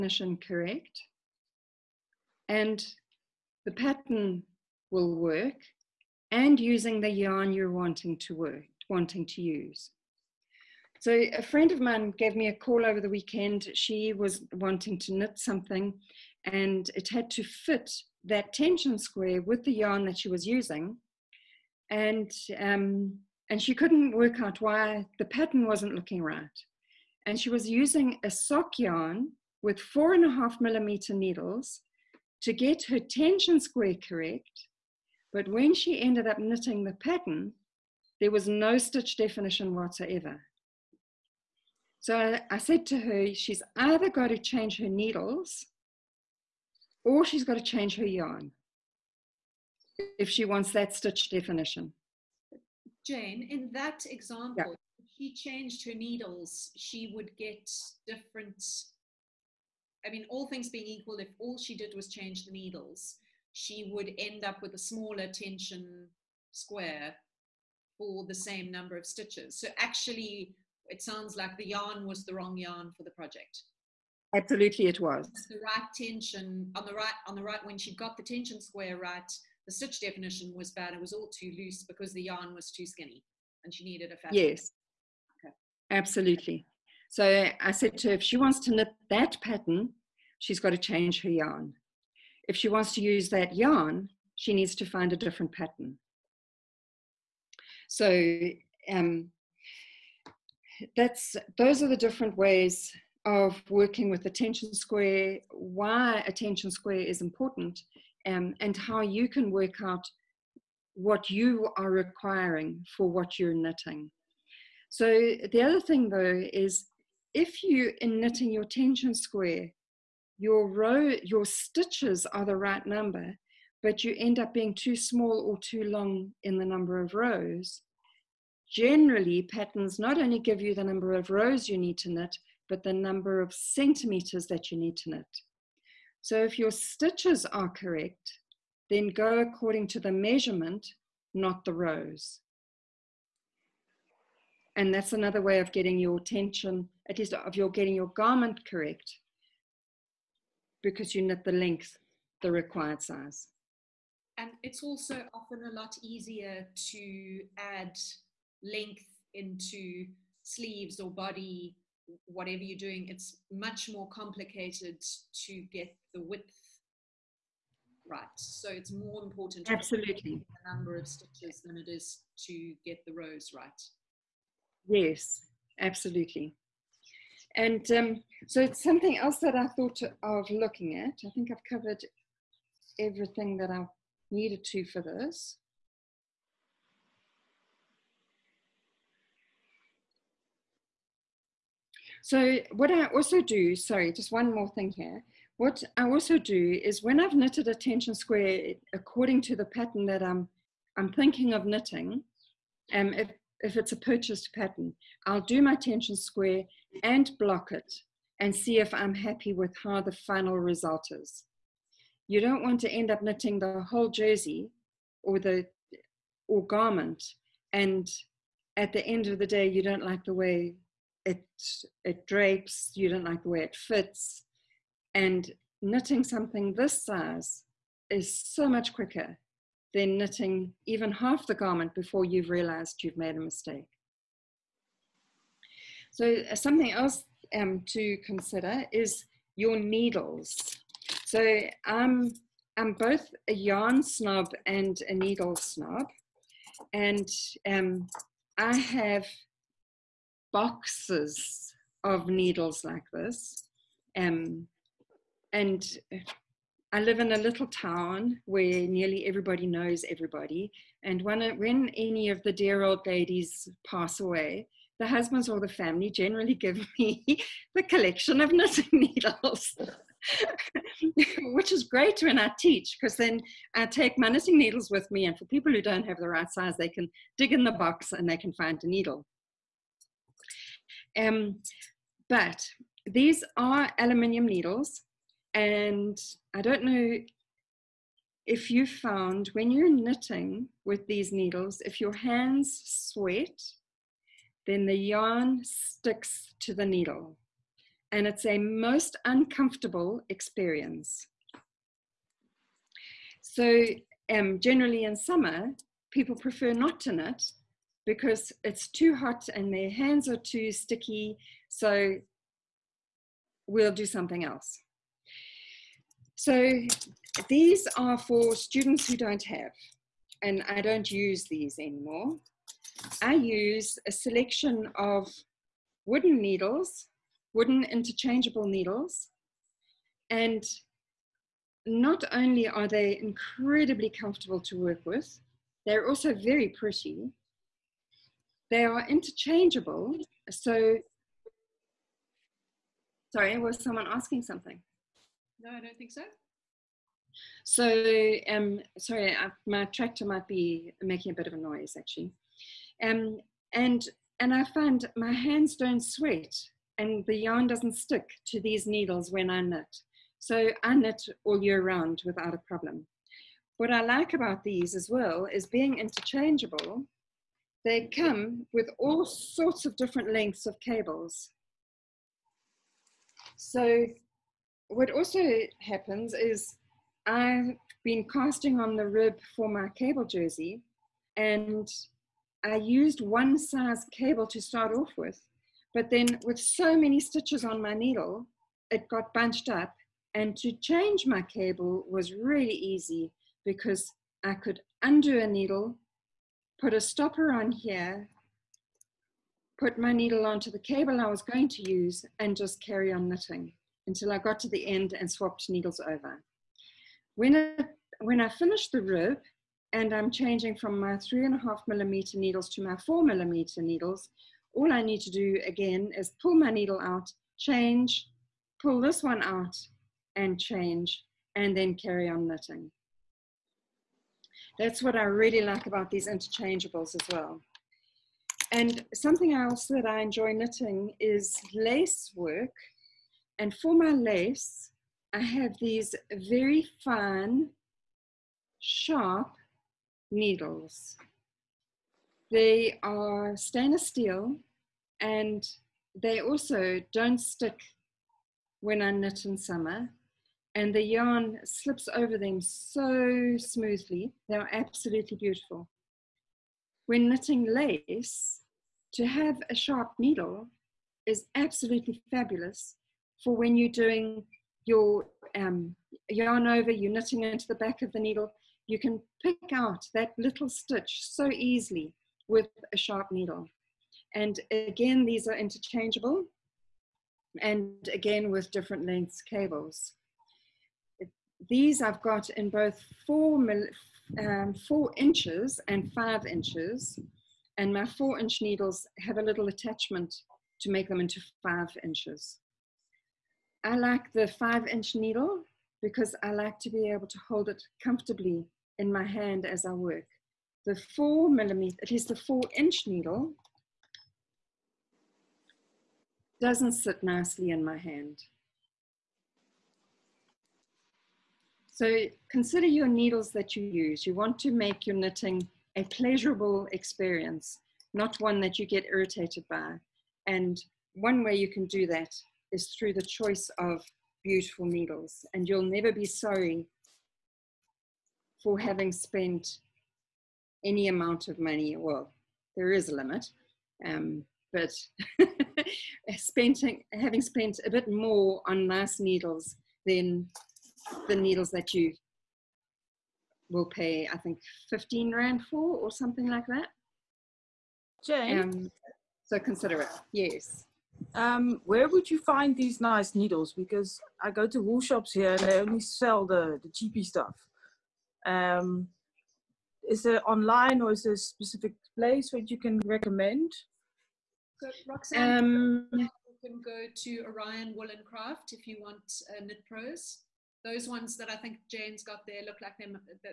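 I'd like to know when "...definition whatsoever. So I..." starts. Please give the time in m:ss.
0:39.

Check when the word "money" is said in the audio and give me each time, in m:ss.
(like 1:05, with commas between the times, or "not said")
8:51.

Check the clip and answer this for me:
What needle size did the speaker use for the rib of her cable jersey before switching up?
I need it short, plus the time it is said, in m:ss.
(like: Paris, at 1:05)
3.5 millimeter, at 6:51.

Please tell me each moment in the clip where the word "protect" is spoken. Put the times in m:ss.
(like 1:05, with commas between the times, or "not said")
not said.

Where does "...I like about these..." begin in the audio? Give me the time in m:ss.
6:03.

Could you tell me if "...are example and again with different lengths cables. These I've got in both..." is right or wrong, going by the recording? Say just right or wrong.
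wrong.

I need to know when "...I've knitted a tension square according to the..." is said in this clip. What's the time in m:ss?
3:17.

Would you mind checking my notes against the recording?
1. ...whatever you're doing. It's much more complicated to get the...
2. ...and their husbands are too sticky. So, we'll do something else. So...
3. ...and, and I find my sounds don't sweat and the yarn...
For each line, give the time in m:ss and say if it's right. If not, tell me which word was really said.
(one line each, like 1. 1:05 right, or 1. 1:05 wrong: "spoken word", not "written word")
1. 2:42 right
2. 5:09 wrong: "hands", not "husbands"
3. 5:53 wrong: "hands", not "sounds".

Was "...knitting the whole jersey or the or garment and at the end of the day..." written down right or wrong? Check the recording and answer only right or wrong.
right.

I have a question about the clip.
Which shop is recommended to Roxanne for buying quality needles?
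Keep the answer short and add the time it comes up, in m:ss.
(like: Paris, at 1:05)
Orion Wool and Craft, at 9:27.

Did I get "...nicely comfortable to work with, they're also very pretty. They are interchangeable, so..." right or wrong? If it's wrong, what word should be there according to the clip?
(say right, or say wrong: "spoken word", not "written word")
wrong: "incredibly", not "nicely".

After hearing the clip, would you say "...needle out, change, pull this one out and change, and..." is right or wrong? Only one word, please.
right.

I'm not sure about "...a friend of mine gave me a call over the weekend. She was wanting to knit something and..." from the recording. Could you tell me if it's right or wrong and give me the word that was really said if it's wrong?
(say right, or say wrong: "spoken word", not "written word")
right.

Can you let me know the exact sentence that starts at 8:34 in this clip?
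You want to make your knitting a pleasurable experience, not one that you get irritated by.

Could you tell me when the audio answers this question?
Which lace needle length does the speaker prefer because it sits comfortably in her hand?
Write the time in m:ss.
8:14.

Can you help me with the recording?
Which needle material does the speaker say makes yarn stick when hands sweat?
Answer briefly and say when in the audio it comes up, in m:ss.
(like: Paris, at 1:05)
Aluminium, at 4:43.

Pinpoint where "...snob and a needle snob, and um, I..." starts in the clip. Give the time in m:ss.
4:04.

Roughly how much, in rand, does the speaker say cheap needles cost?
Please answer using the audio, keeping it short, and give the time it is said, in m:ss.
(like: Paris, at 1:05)
15 Rand, at 9:04.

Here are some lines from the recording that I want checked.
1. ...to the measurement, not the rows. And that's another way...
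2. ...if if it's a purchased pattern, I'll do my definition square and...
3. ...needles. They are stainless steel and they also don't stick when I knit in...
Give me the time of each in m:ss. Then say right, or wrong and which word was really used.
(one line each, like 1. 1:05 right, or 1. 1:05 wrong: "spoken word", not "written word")
1. 2:19 right
2. 3:23 wrong: "tension", not "definition"
3. 7:20 right.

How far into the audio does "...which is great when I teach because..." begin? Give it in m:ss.
4:31.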